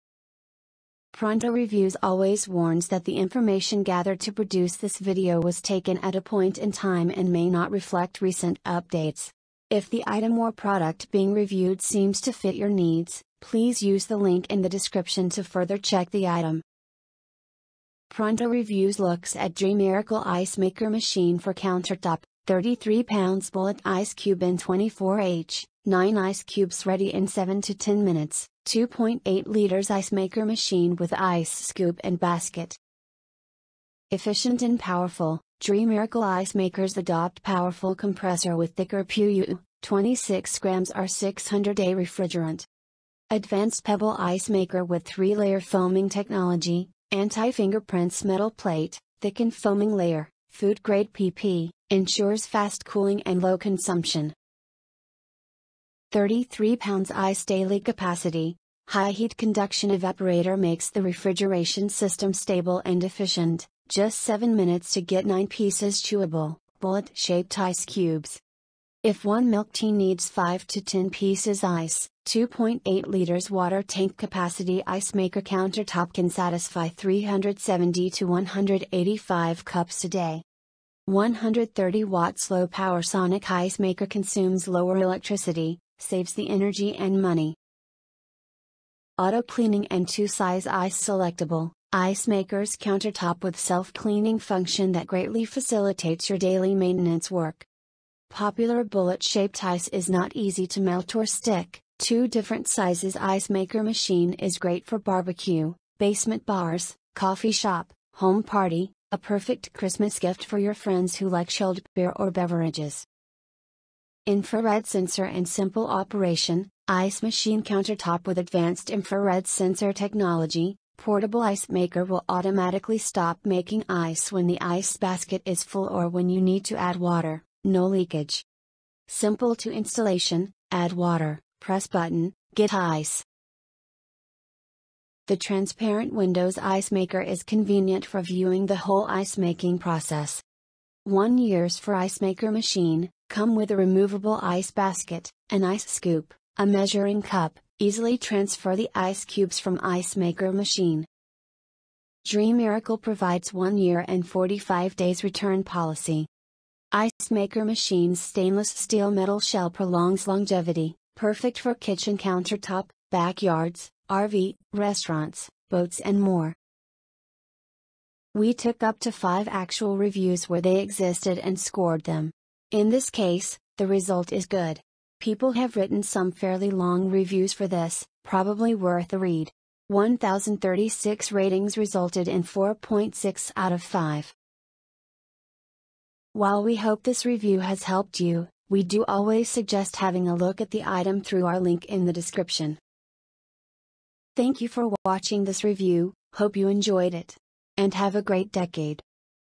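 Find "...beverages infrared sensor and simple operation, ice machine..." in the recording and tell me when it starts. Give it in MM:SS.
01:52.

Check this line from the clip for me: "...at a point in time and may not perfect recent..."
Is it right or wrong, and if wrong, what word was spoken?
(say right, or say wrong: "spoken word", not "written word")
wrong: "reflect", not "perfect".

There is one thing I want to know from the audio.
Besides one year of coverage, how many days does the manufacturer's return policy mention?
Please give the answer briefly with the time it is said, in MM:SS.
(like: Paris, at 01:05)
45 days, at 02:34.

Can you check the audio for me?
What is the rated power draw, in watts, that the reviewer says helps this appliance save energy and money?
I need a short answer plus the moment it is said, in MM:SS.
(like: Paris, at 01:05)
130 watt, at 01:21.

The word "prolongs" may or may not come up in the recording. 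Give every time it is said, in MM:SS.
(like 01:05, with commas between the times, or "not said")
02:39.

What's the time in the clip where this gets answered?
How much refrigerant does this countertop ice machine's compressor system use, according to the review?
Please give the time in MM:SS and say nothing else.
00:39.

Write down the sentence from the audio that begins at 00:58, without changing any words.
High heat conduction evaporator makes the refrigeration system stable and efficient.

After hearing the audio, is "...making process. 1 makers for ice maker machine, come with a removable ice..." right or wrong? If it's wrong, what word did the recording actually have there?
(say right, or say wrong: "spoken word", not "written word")
wrong: "years", not "makers".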